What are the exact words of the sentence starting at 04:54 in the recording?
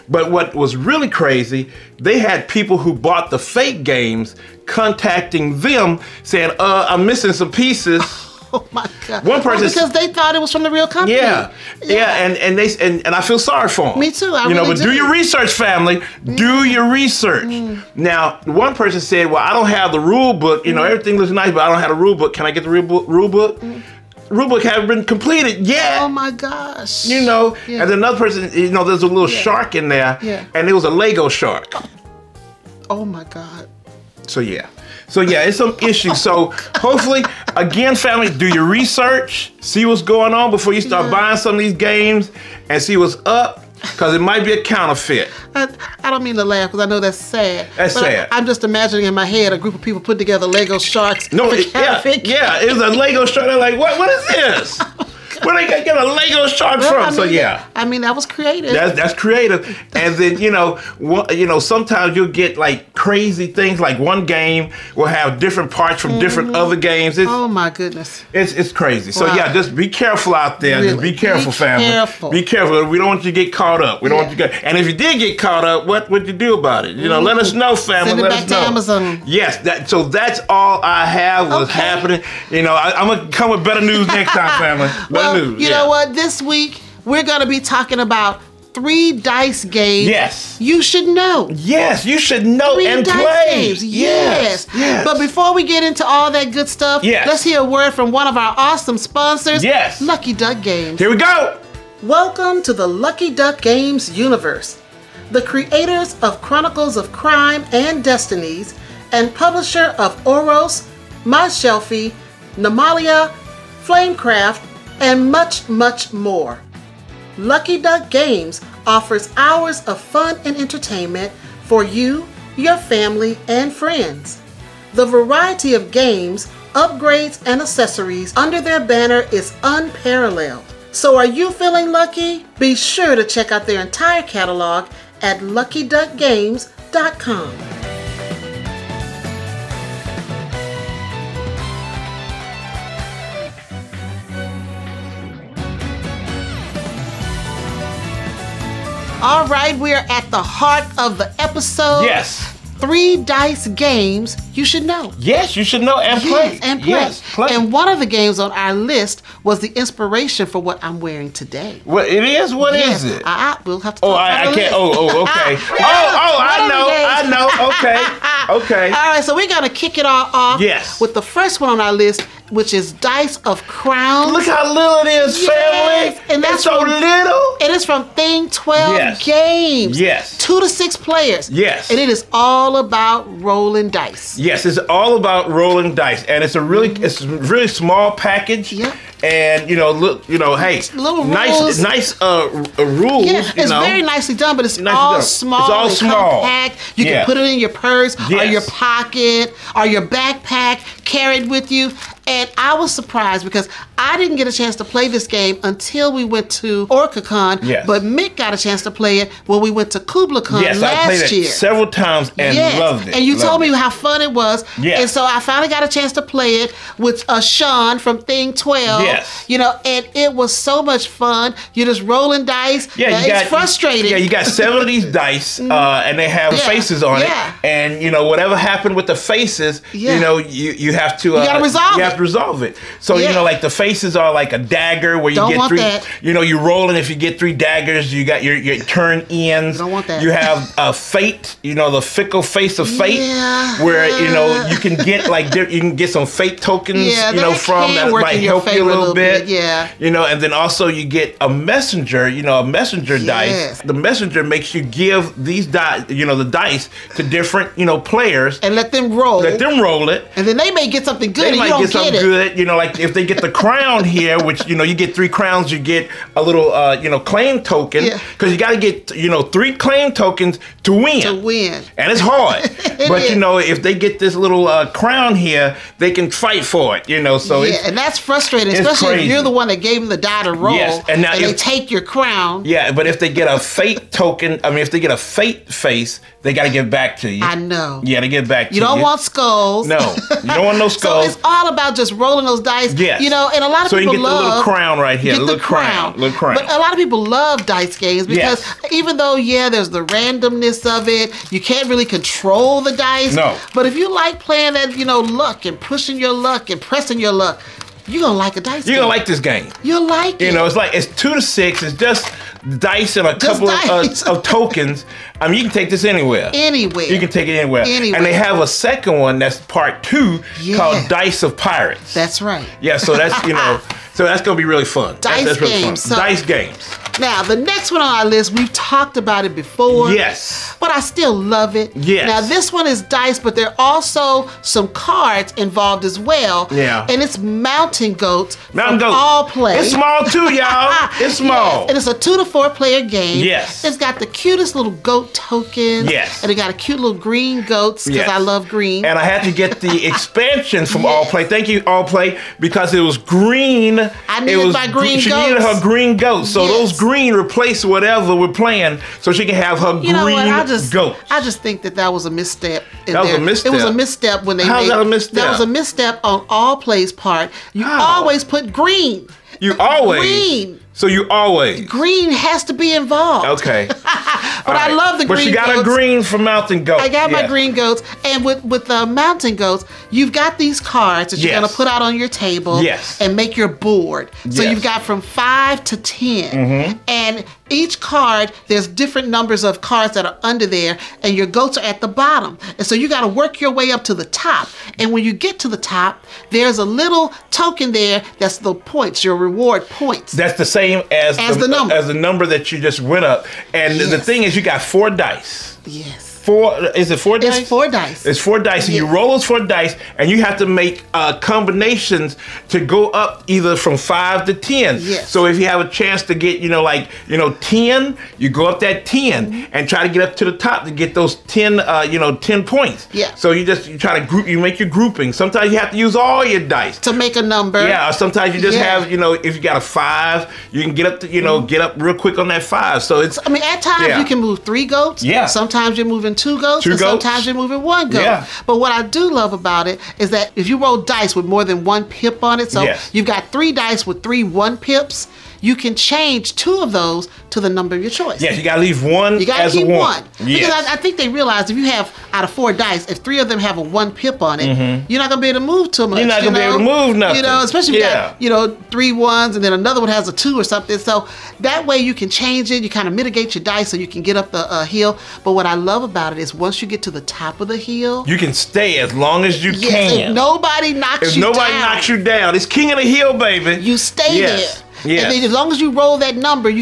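So you get the little crown right here.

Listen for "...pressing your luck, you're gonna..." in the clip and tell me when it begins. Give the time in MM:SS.
05:06.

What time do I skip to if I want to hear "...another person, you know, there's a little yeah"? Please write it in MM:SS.
00:27.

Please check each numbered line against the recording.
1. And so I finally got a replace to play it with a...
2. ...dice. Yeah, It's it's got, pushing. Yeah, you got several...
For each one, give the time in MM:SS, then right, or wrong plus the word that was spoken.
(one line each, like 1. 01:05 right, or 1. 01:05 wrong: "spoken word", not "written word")
1. 03:35 wrong: "chance", not "replace"
2. 03:42 wrong: "frustrating", not "pushing".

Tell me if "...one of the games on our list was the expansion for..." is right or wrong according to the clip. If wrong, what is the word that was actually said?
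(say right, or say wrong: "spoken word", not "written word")
wrong: "inspiration", not "expansion".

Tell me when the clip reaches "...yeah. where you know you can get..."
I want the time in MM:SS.
04:03.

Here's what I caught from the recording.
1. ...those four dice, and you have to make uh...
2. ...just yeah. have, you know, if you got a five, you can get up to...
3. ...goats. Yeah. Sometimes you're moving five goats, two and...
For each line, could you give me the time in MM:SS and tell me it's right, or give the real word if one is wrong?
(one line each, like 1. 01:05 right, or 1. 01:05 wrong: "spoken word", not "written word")
1. 06:49 right
2. 07:08 right
3. 07:14 wrong: "two", not "five".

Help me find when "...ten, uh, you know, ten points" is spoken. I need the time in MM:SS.
07:01.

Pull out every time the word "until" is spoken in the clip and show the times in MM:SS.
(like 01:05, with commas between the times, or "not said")
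03:25.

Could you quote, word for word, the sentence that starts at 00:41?
buying some of these games, and see what's up.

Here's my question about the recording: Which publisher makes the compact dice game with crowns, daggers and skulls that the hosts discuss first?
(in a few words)
Thing 12 Games.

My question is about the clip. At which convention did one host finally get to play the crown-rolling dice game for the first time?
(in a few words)
OrcaCon.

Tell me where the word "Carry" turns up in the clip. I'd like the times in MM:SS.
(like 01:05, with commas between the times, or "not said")
03:21.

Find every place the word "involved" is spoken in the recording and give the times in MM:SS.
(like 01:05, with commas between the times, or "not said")
05:35, 06:12.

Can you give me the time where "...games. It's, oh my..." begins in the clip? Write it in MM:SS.
01:06.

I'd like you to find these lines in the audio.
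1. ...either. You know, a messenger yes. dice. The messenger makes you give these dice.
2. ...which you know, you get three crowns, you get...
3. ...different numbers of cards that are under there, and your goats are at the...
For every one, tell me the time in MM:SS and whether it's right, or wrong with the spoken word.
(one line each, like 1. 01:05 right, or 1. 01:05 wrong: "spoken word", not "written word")
1. 04:11 wrong: "messenger", not "either"
2. 04:24 right
3. 06:28 right.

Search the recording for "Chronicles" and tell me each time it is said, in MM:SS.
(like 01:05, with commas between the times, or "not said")
01:46.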